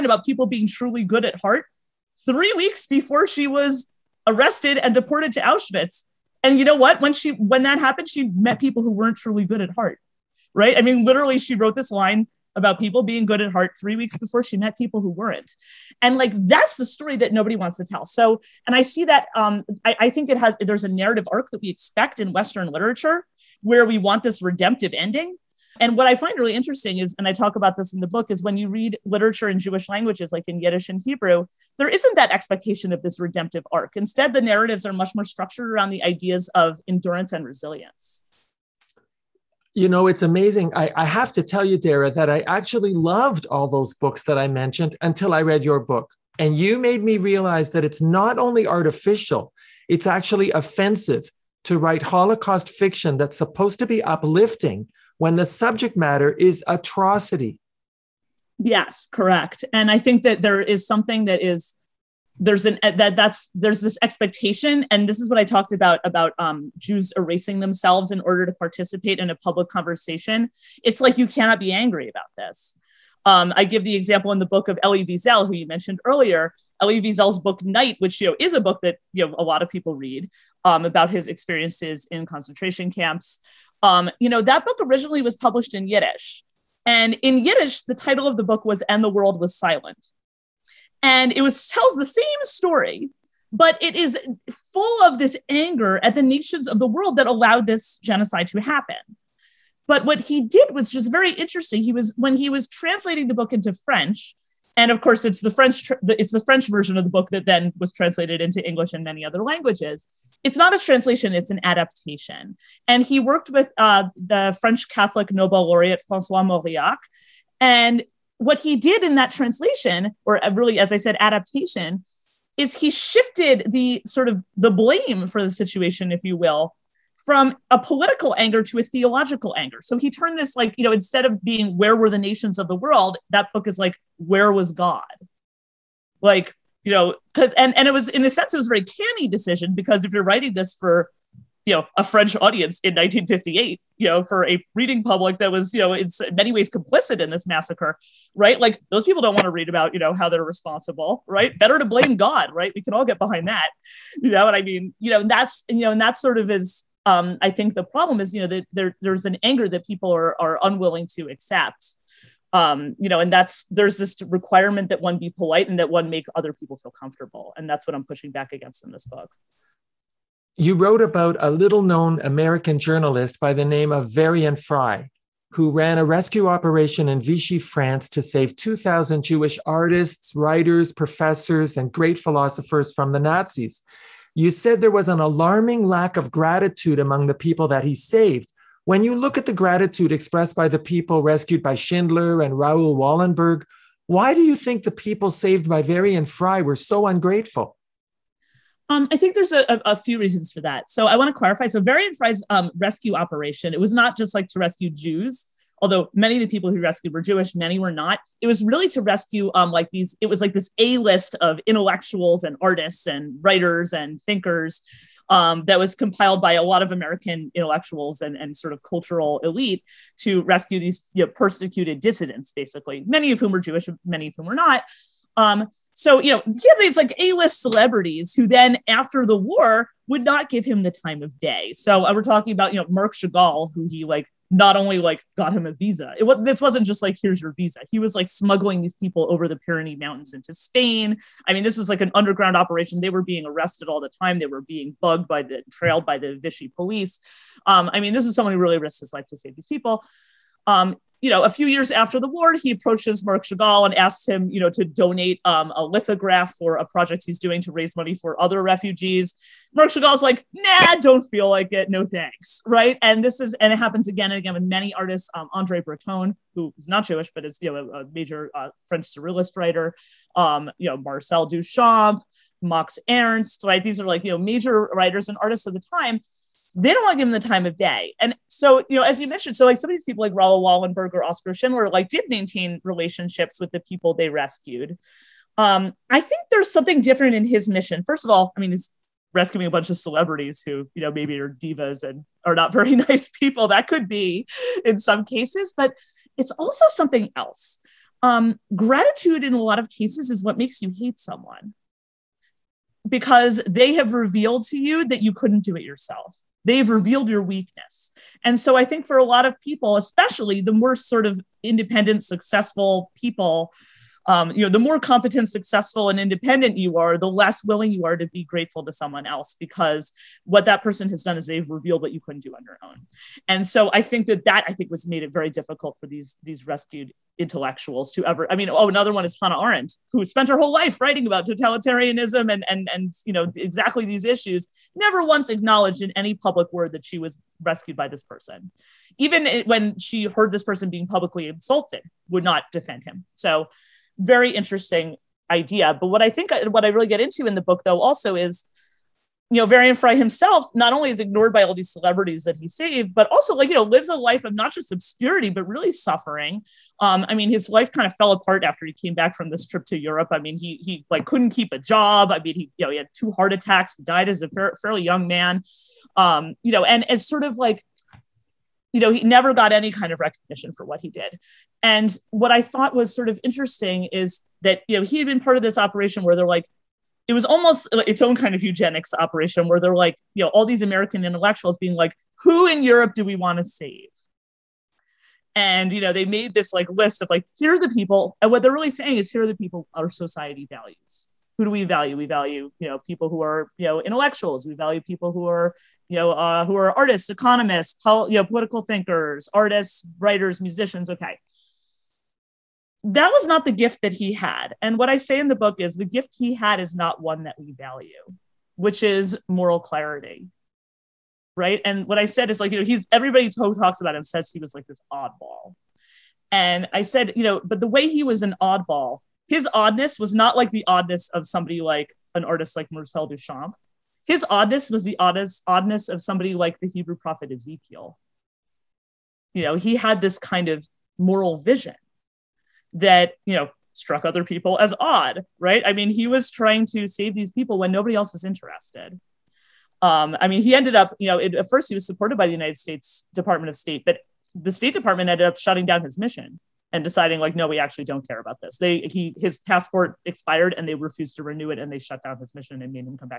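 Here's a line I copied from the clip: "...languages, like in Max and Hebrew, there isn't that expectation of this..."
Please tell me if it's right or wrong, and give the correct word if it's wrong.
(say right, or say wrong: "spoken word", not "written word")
wrong: "Yiddish", not "Max".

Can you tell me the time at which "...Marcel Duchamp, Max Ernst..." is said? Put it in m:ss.
4:30.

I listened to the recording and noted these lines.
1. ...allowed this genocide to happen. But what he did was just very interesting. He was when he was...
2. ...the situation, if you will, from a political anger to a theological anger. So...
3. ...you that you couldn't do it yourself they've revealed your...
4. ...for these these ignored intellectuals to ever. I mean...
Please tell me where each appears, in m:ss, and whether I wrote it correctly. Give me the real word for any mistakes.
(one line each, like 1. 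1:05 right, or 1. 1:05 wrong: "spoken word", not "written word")
1. 1:37 right
2. 2:05 right
3. 5:04 right
4. 5:25 wrong: "rescued", not "ignored".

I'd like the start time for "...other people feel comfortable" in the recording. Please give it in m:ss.
2:46.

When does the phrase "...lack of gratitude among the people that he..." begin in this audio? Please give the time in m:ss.
3:05.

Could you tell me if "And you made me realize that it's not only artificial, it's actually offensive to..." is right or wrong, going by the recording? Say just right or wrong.
right.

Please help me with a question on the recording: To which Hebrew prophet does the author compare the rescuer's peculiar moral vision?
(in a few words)
Ezekiel.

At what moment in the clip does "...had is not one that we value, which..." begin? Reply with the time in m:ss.
6:46.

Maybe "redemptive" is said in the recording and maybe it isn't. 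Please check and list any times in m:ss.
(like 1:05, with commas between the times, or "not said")
0:24, 0:33.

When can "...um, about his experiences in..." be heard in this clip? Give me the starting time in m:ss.
1:20.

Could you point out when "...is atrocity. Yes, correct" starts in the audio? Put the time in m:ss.
0:56.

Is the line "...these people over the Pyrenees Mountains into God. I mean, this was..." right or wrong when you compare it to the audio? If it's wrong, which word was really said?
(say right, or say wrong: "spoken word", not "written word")
wrong: "Spain", not "God".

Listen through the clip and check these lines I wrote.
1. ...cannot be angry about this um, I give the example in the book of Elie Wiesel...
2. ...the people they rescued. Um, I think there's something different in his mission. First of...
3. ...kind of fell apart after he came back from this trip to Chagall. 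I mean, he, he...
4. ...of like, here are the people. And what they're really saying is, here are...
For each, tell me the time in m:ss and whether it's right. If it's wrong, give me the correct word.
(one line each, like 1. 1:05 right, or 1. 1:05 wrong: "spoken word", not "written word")
1. 1:11 right
2. 4:43 right
3. 5:57 wrong: "Europe", not "Chagall"
4. 6:27 right.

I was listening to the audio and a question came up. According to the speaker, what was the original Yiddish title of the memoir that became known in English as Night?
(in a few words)
And the World Was Silent.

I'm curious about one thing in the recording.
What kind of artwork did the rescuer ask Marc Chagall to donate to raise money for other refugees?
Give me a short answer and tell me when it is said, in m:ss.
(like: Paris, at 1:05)
A lithograph, at 4:15.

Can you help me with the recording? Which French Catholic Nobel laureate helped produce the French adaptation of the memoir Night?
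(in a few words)
Francois Mauriac.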